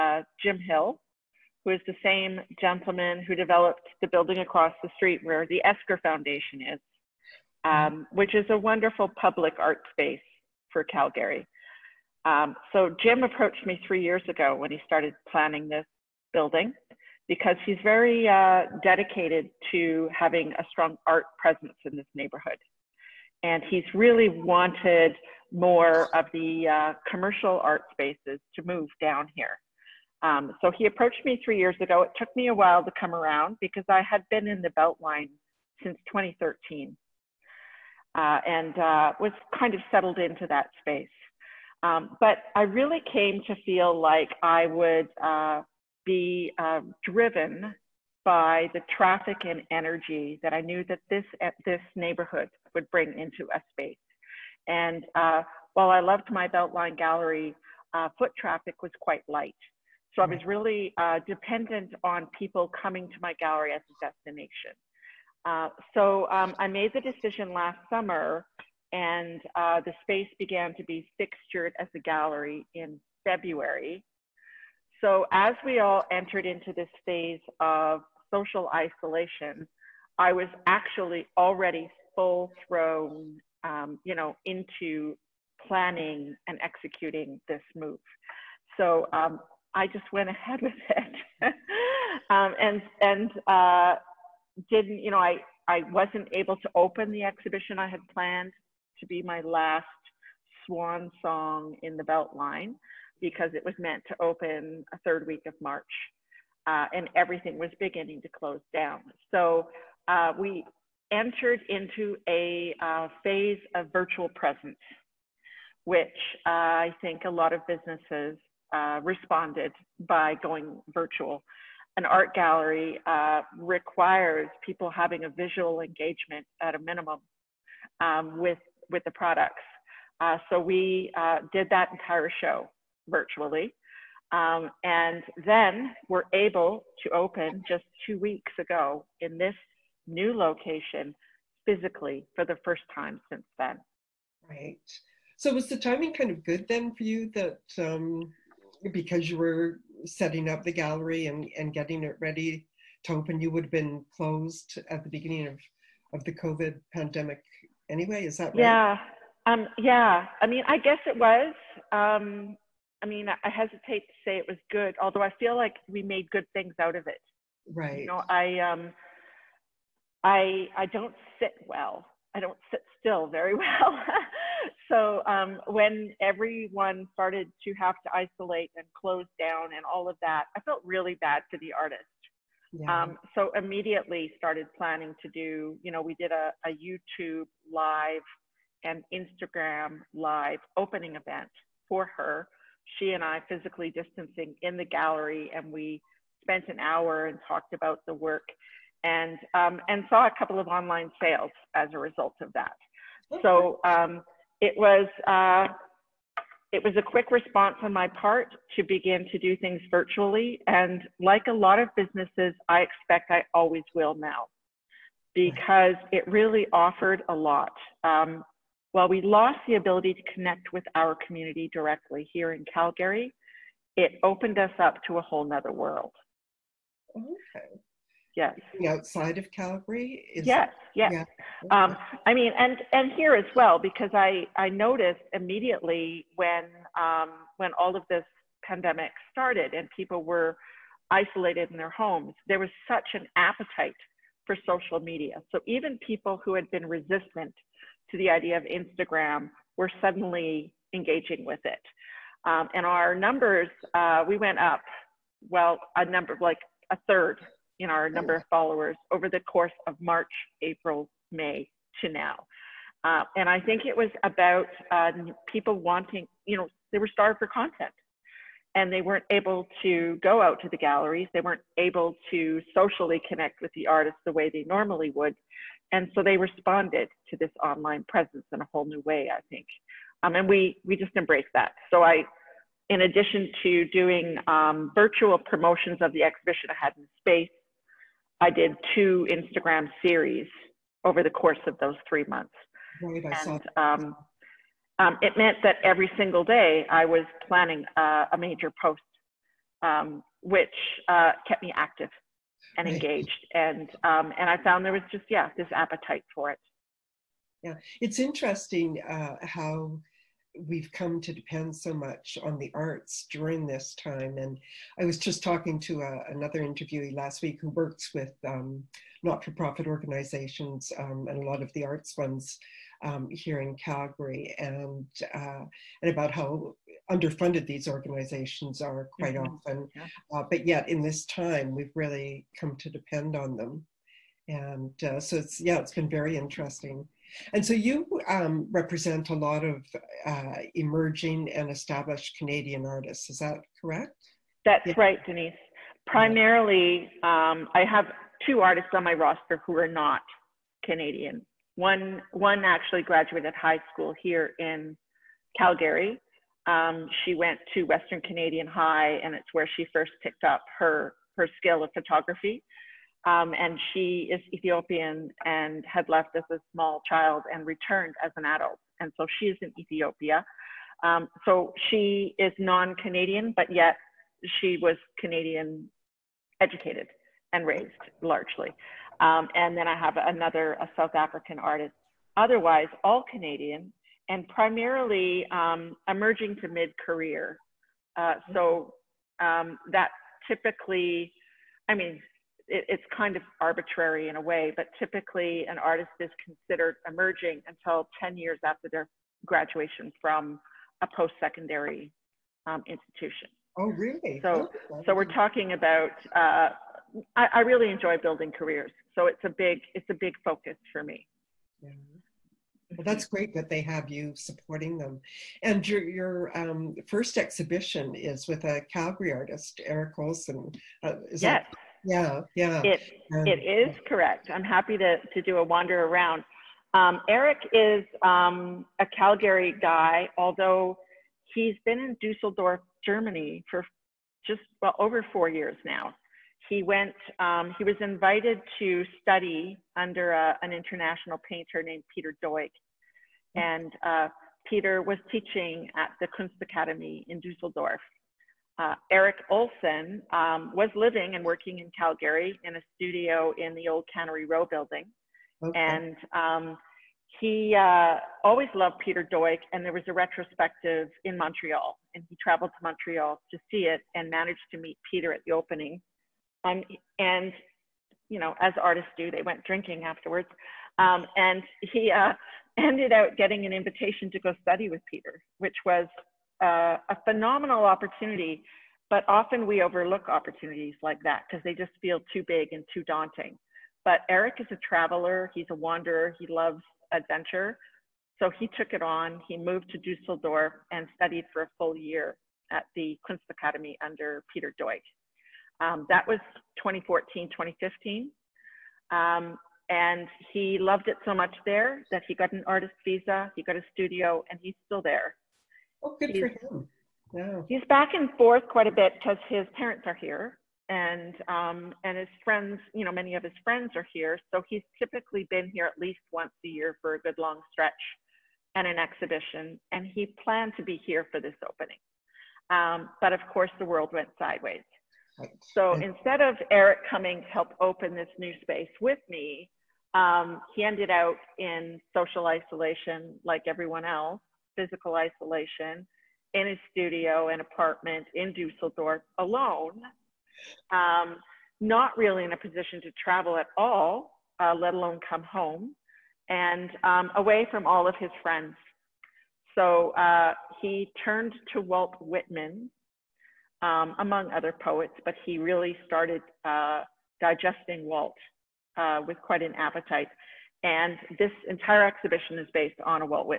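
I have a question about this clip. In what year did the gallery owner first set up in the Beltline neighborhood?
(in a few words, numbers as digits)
2013.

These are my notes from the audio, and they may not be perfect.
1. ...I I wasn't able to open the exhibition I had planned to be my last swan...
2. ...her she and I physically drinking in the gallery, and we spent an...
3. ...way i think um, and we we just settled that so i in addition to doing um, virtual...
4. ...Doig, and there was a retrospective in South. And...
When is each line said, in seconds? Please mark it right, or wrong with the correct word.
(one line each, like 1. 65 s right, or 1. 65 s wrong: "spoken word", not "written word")
1. 95 s right
2. 192 s wrong: "distancing", not "drinking"
3. 279 s wrong: "embraced", not "settled"
4. 459 s wrong: "Montreal", not "South".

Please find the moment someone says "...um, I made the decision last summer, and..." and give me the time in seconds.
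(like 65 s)
66 s.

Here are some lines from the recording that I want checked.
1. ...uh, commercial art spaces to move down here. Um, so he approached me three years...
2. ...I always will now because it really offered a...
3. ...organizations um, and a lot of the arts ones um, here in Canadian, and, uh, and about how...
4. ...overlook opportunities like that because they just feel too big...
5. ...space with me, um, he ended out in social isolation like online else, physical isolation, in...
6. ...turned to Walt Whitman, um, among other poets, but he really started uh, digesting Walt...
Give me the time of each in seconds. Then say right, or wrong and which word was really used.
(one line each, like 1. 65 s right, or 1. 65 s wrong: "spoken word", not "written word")
1. 26 s right
2. 213 s right
3. 319 s wrong: "Calgary", not "Canadian"
4. 479 s right
5. 528 s wrong: "everyone", not "online"
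6. 551 s right.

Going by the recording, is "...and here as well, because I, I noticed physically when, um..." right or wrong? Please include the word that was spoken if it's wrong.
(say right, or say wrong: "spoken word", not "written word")
wrong: "immediately", not "physically".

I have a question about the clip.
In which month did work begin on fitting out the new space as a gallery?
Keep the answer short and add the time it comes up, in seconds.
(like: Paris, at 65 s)
February, at 73 s.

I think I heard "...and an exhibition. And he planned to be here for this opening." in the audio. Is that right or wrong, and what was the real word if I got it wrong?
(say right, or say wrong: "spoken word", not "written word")
right.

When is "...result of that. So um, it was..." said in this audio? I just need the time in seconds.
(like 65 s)
201 s.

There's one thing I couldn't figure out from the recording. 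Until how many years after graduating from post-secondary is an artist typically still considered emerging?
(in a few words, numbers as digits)
10.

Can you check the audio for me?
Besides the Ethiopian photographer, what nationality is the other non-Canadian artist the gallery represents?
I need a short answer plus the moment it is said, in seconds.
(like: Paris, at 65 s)
South African, at 380 s.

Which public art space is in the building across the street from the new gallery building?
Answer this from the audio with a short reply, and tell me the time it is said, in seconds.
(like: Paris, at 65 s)
Esker Foundation, at 5 s.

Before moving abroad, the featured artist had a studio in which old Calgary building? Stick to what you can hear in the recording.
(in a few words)
Cannery Row.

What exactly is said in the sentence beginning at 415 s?
And your, your um, first exhibition is with a Calgary artist, Erik Olson.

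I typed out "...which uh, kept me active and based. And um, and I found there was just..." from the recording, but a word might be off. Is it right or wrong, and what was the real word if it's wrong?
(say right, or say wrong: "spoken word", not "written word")
wrong: "engaged", not "based".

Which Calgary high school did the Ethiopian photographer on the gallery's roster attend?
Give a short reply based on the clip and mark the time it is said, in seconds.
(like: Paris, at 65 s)
Western Canadian High, at 357 s.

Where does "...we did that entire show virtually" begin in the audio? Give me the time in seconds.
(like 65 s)
130 s.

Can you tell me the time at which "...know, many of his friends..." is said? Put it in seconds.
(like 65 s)
513 s.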